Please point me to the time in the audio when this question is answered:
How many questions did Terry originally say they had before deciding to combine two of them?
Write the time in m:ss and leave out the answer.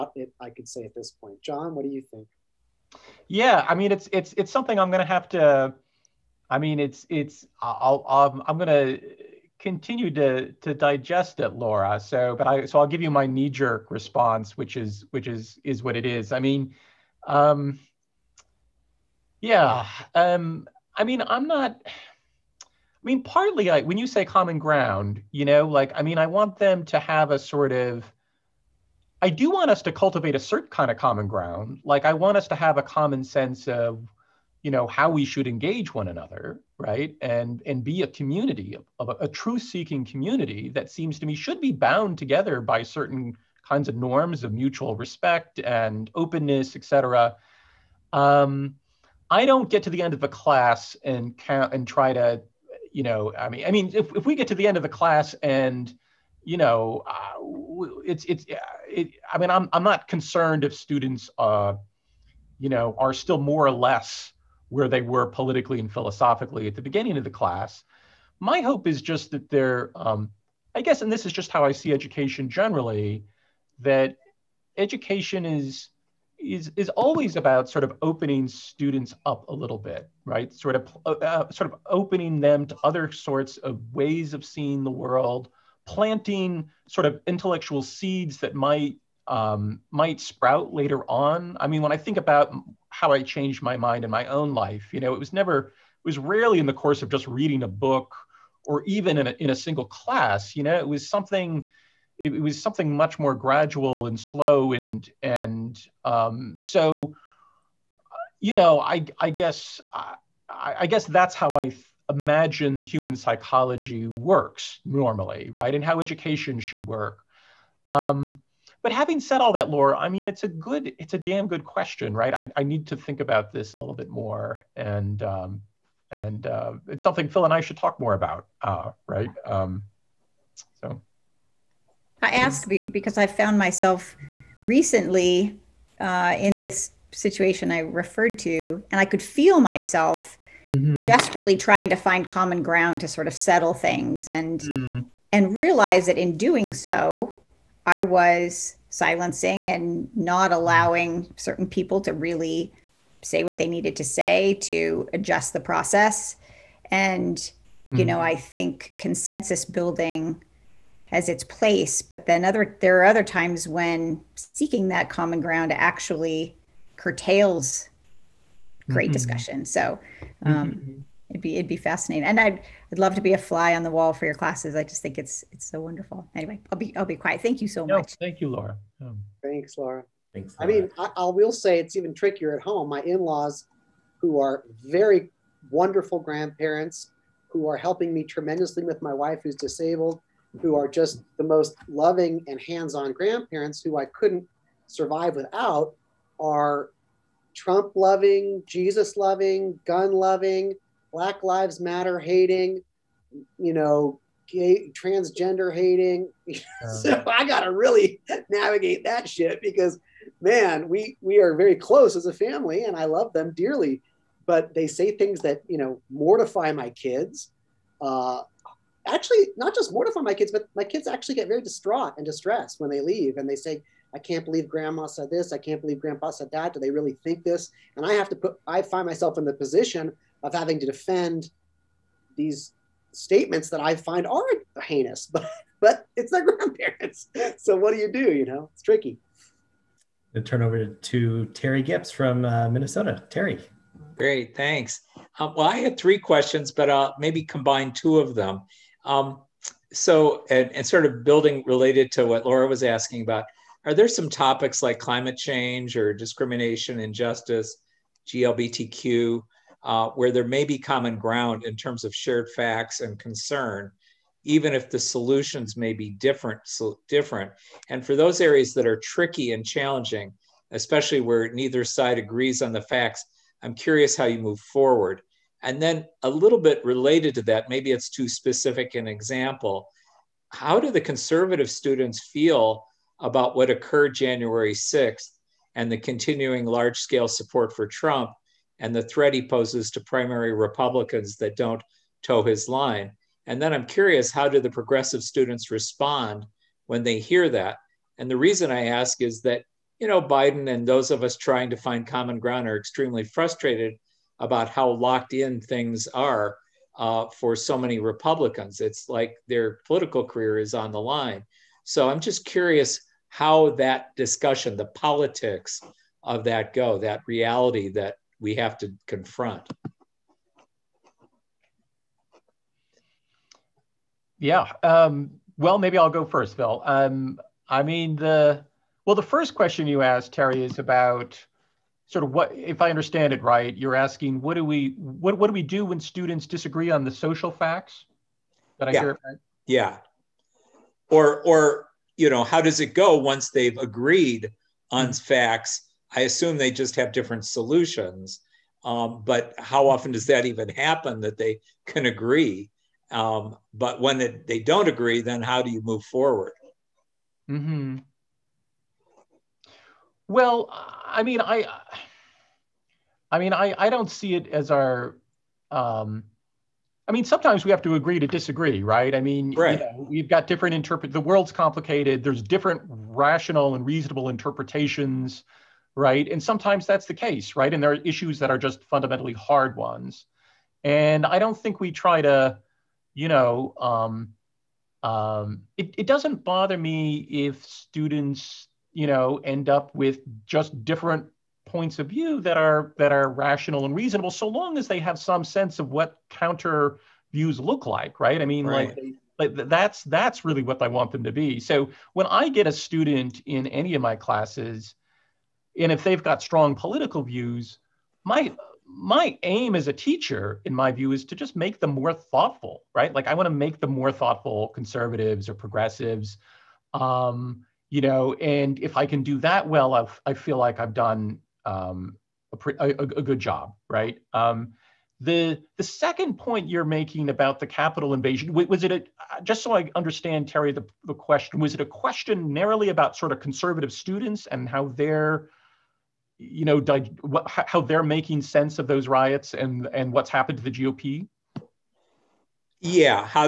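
4:05.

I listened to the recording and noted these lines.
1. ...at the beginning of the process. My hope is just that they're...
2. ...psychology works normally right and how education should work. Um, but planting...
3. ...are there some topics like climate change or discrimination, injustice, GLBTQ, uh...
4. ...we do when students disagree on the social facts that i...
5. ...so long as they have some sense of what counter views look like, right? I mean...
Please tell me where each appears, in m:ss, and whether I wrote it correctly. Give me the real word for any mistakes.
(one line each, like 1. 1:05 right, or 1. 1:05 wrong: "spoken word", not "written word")
1. 1:06 wrong: "class", not "process"
2. 1:53 wrong: "having", not "planting"
3. 4:13 right
4. 5:35 right
5. 6:34 right.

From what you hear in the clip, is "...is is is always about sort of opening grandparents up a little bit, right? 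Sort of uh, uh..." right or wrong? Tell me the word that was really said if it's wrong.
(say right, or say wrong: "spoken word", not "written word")
wrong: "students", not "grandparents".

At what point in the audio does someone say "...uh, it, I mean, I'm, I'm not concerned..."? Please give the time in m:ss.
0:58.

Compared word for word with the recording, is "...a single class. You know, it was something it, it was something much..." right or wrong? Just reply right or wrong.
right.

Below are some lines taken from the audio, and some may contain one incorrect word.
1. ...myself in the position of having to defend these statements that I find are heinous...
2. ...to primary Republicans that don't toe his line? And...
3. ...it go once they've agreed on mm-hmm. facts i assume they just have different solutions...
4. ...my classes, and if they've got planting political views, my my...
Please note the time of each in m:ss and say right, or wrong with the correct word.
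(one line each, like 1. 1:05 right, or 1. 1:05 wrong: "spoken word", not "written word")
1. 3:49 right
2. 4:49 right
3. 5:42 right
4. 6:44 wrong: "strong", not "planting".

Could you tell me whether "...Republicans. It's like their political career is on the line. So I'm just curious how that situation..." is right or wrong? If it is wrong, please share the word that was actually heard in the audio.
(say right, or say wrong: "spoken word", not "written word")
wrong: "discussion", not "situation".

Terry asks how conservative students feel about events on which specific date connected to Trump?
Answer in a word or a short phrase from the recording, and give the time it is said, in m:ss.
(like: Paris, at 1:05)
January 6th, at 4:44.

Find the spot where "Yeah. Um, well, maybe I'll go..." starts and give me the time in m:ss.
5:24.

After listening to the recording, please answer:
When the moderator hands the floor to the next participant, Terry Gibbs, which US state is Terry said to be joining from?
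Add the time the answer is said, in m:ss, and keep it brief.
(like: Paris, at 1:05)
Minnesota, at 4:02.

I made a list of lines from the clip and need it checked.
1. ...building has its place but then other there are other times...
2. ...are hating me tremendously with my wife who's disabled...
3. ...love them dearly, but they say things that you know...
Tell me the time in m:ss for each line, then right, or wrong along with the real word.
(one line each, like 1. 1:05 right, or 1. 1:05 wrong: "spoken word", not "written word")
1. 2:39 right
2. 3:07 wrong: "helping", not "hating"
3. 3:33 right.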